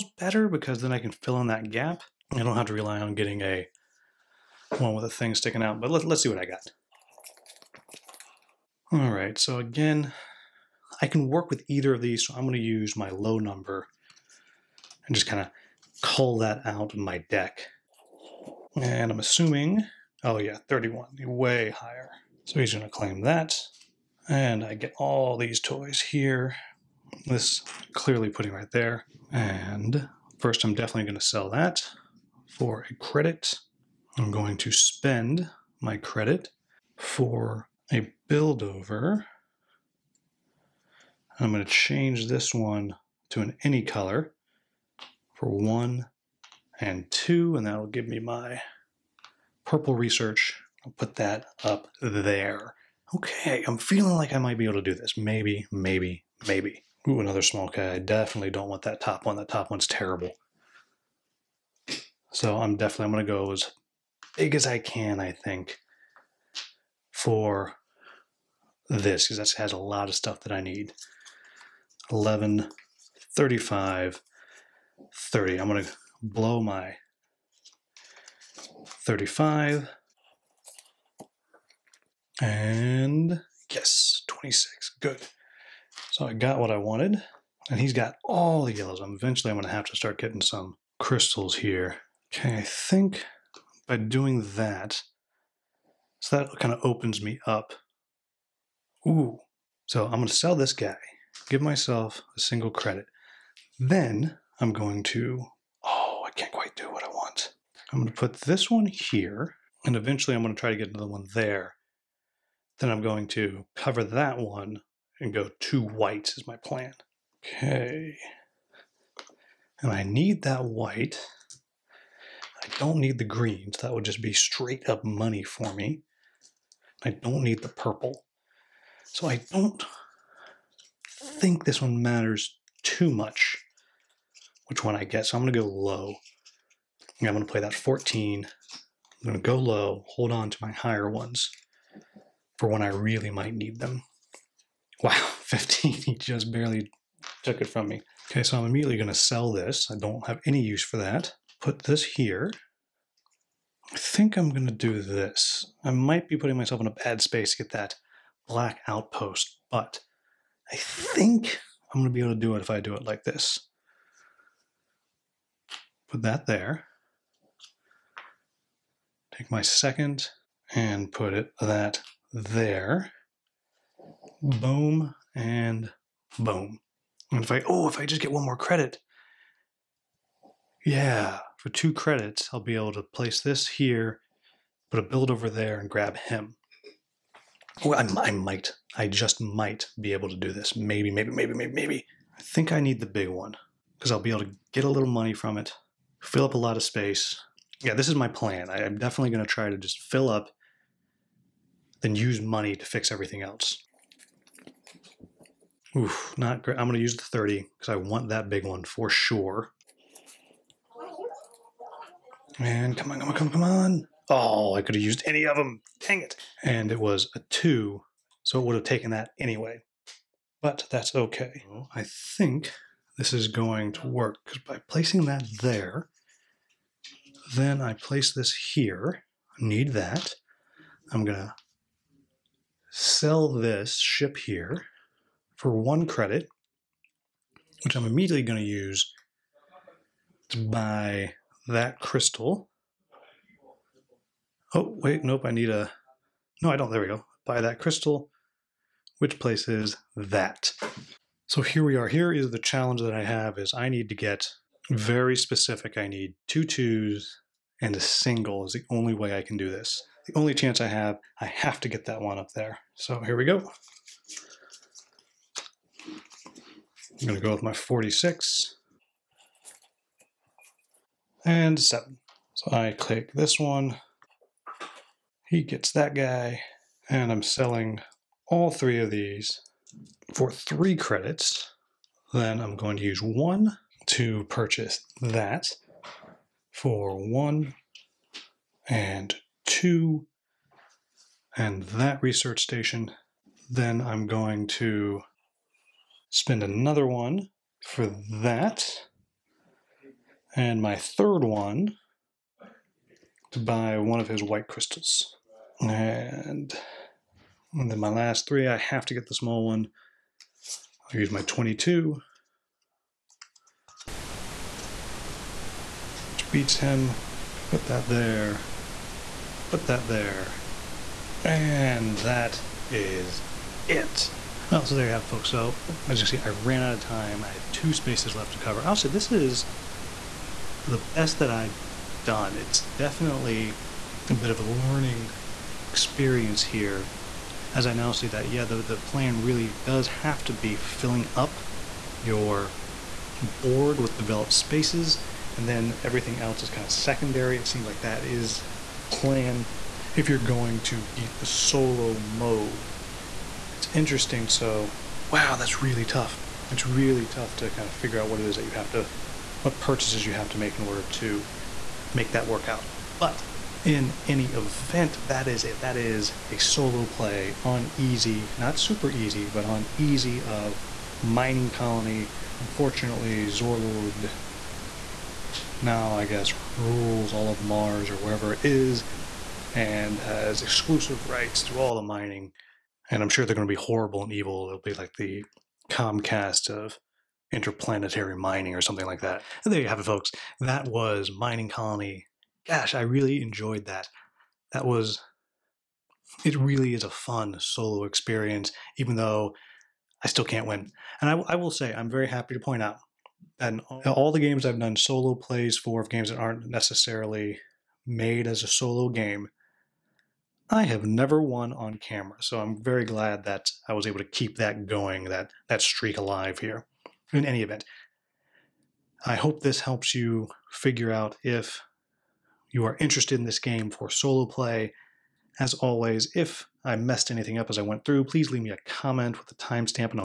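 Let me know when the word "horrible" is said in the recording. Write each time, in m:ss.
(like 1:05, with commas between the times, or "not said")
6:23.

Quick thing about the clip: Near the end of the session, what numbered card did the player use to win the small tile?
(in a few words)
22.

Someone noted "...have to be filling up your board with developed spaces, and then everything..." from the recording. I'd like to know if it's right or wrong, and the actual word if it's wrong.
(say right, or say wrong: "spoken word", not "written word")
right.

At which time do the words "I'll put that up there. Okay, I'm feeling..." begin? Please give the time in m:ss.
0:50.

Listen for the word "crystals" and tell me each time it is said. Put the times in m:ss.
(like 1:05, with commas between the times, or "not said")
1:30, 4:01, 4:07, 5:04.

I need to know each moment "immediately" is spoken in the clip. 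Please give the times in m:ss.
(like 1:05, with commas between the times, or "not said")
2:28, 3:58.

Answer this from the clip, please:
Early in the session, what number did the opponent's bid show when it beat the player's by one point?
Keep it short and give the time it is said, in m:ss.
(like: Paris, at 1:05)
31, at 0:20.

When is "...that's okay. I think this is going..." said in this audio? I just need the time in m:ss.
3:40.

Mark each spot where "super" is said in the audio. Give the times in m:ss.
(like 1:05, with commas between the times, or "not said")
6:08.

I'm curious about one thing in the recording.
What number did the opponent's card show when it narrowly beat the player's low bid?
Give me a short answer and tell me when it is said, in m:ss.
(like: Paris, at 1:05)
15, at 2:25.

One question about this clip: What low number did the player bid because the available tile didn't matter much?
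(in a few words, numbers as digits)
14.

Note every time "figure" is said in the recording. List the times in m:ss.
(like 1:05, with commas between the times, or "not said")
5:57, 7:00.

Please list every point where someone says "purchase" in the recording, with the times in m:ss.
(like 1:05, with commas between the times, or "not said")
4:44, 5:59.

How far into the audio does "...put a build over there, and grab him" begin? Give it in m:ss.
3:04.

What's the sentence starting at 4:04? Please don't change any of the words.
Oh, wait, nope, I need a, no, I don't, there we go.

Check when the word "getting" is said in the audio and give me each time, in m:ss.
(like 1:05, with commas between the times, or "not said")
0:03, 1:30.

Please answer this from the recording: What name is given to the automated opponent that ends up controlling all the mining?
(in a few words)
Zorlord.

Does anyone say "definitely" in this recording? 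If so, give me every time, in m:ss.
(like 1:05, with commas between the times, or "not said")
0:30, 0:57, 1:02, 3:18, 5:32.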